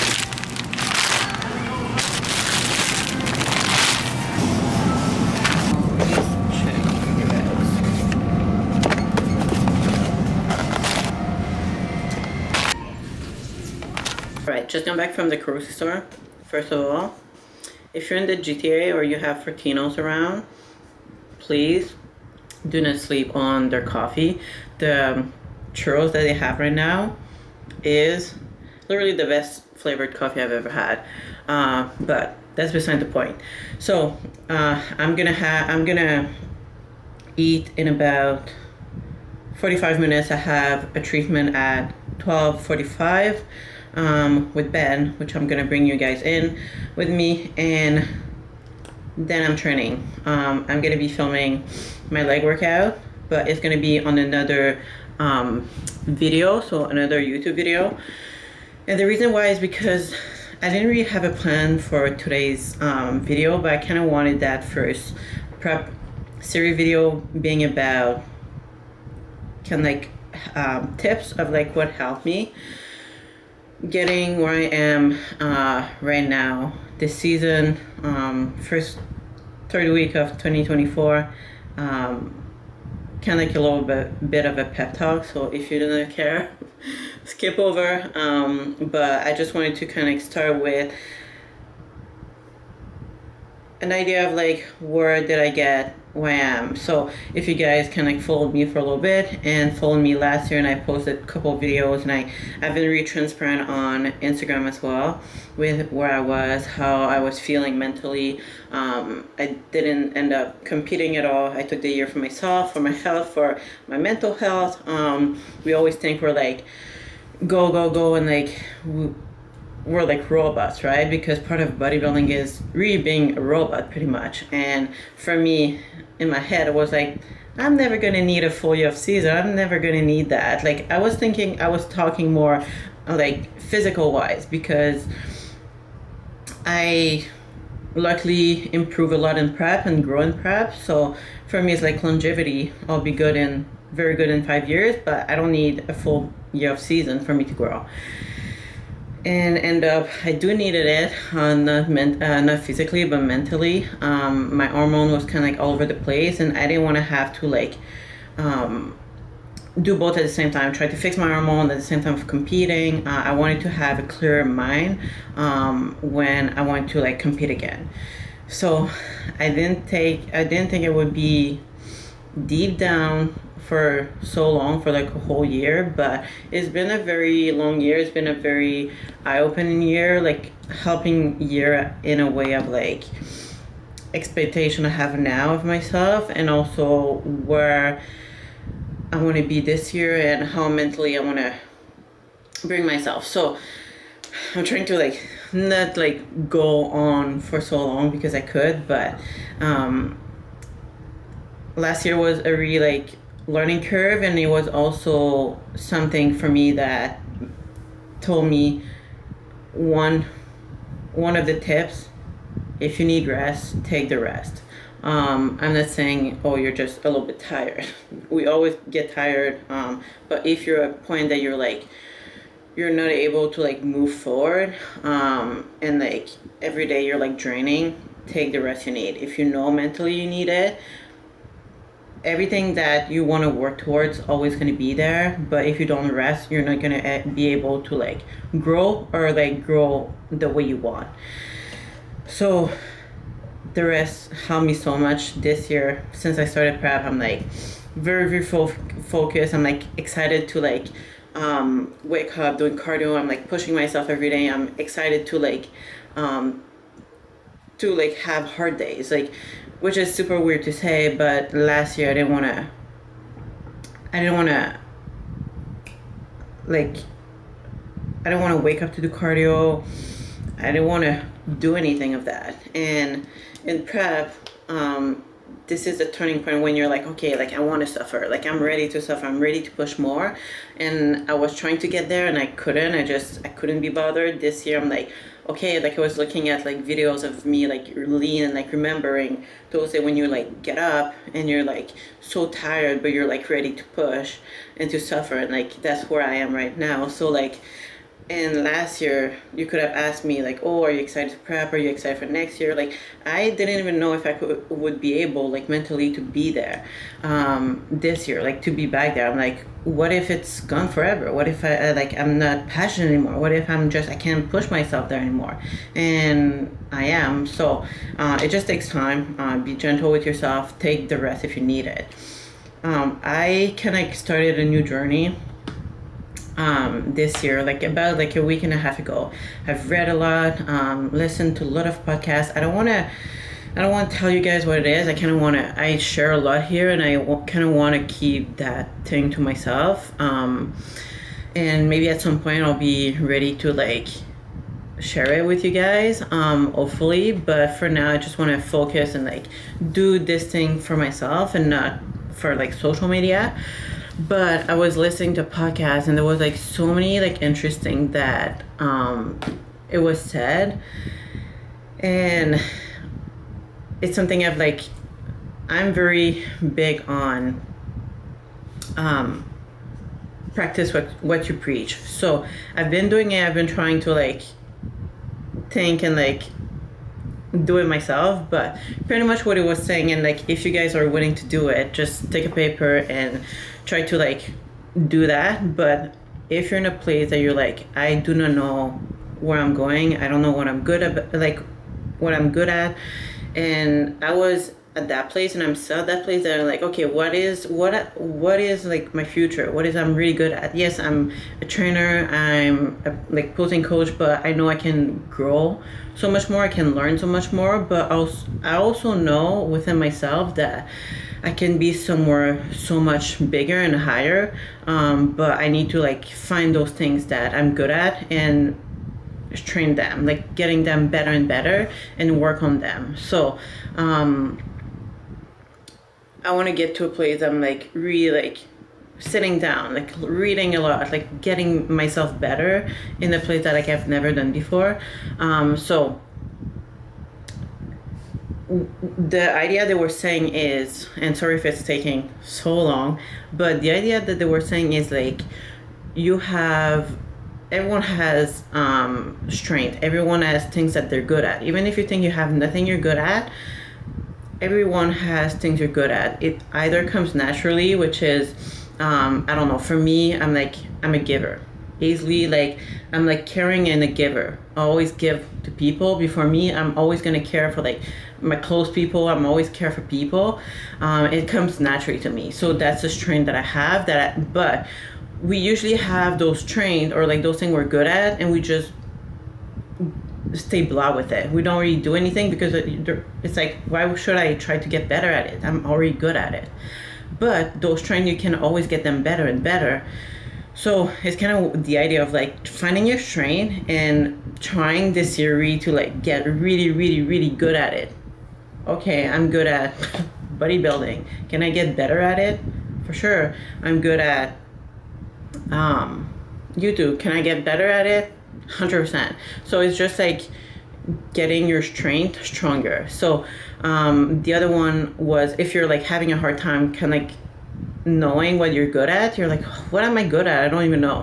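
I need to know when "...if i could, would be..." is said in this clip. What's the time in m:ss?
5:04.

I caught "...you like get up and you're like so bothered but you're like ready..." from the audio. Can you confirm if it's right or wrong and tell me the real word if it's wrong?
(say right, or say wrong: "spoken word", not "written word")
wrong: "tired", not "bothered".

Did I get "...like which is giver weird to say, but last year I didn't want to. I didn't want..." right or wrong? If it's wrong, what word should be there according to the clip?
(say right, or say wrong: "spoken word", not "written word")
wrong: "super", not "giver".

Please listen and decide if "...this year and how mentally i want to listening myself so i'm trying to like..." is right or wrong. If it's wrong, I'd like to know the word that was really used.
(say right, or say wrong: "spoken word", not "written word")
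wrong: "bring", not "listening".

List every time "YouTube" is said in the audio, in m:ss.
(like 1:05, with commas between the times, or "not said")
0:57, 8:26.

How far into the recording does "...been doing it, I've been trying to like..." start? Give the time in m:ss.
6:12.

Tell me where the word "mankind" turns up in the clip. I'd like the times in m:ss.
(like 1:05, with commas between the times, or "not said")
not said.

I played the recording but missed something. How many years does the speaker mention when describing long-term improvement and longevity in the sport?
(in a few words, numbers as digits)
5.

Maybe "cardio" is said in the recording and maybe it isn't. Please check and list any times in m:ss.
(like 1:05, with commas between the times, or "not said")
4:12, 4:29.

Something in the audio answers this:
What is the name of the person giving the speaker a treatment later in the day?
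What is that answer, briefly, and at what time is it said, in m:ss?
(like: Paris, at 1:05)
Ben, at 0:44.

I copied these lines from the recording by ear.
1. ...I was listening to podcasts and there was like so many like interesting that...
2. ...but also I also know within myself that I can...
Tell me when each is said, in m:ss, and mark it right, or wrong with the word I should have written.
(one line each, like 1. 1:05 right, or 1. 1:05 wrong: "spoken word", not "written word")
1. 5:54 right
2. 6:47 right.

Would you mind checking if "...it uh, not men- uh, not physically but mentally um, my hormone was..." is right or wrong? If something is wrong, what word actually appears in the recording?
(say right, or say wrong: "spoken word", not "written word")
right.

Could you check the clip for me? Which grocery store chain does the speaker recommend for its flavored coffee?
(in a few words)
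Fortinos.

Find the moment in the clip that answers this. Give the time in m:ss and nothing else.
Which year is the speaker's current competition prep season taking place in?
1:20.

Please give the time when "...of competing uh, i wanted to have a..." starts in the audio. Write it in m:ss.
2:42.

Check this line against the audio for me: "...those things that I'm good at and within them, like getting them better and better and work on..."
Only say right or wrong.
wrong.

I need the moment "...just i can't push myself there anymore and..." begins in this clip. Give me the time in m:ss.
5:13.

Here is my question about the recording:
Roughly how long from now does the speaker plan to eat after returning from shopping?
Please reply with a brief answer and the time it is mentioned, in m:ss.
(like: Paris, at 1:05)
45 minutes, at 0:39.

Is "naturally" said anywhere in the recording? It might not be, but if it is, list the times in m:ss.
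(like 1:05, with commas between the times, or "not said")
7:37, 7:51.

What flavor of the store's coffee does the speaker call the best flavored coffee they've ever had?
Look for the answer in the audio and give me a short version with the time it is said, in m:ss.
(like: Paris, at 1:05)
Churros, at 0:25.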